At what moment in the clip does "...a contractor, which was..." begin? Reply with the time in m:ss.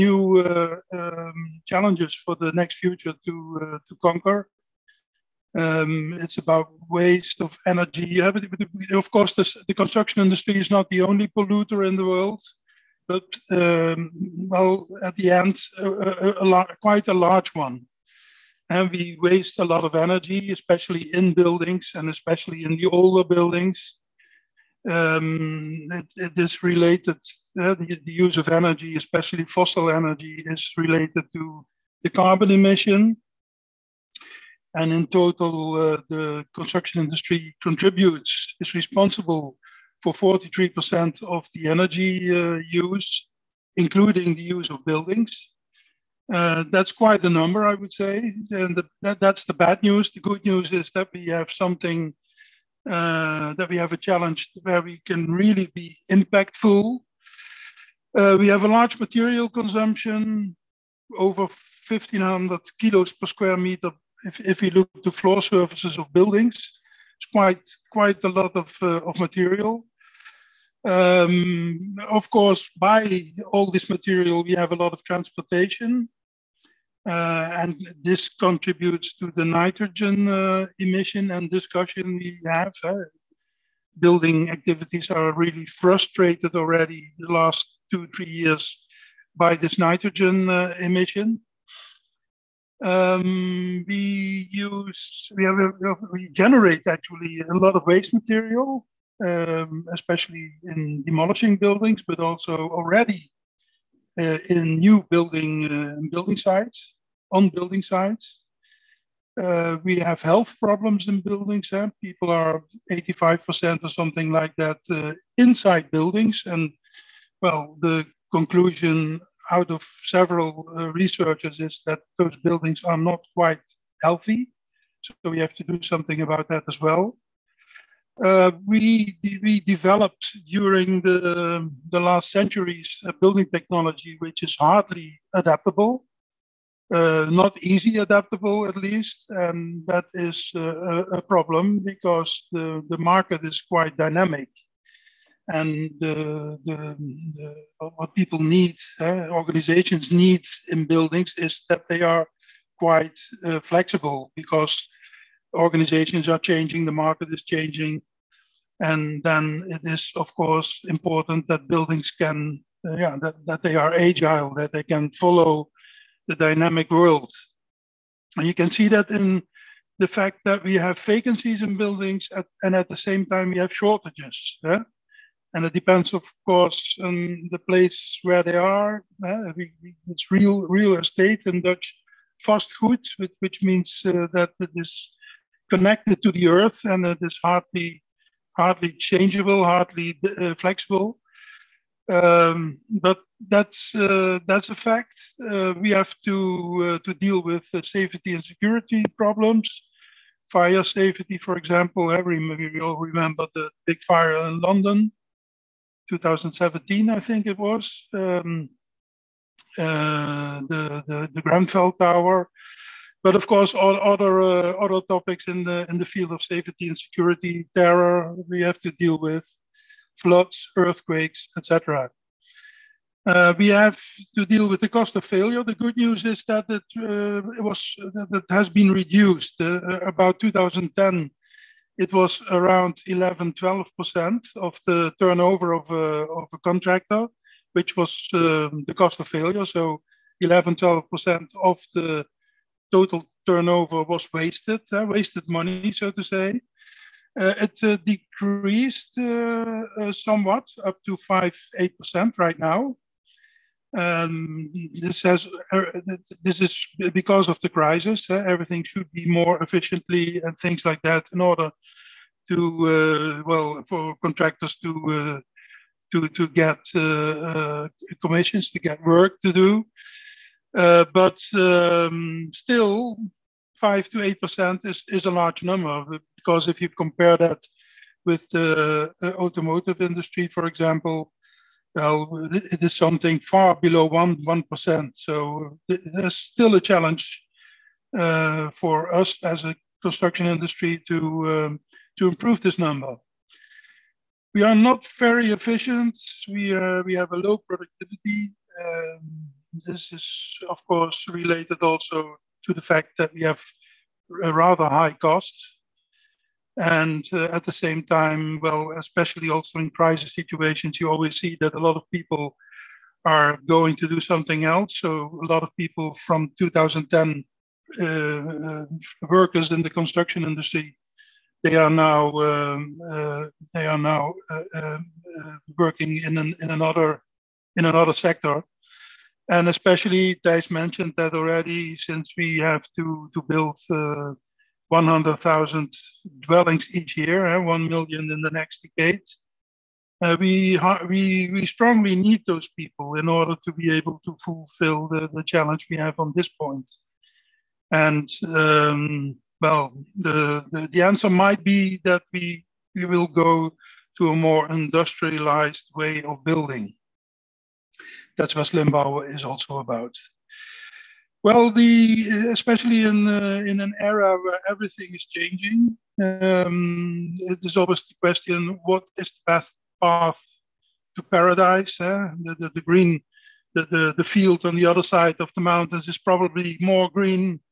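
3:56.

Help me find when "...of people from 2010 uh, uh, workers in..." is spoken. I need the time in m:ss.
5:15.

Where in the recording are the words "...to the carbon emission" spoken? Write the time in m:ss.
0:31.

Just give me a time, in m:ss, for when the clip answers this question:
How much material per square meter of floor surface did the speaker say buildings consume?
1:01.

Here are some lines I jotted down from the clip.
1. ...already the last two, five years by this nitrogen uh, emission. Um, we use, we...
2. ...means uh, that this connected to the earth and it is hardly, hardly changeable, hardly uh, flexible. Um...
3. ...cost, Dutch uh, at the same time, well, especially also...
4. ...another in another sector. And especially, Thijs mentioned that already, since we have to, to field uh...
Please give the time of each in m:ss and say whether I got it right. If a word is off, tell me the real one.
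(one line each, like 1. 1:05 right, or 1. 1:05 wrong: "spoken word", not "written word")
1. 1:26 wrong: "three", not "five"
2. 3:03 right
3. 5:05 wrong: "And", not "Dutch"
4. 5:26 wrong: "build", not "field".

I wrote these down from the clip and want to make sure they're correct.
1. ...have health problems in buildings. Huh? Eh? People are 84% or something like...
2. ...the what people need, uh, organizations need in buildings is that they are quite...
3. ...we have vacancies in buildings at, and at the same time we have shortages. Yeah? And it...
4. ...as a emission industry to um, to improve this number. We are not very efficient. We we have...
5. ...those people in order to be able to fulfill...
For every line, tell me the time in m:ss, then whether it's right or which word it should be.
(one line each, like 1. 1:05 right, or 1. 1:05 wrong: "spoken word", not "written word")
1. 1:49 wrong: "85", not "84"
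2. 2:27 right
3. 2:50 right
4. 4:49 wrong: "construction", not "emission"
5. 5:42 right.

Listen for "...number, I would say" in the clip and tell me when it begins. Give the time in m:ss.
0:47.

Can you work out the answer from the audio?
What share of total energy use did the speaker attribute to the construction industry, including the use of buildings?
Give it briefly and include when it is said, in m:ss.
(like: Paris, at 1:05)
43%, at 0:40.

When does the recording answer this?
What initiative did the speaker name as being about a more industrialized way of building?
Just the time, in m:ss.
5:58.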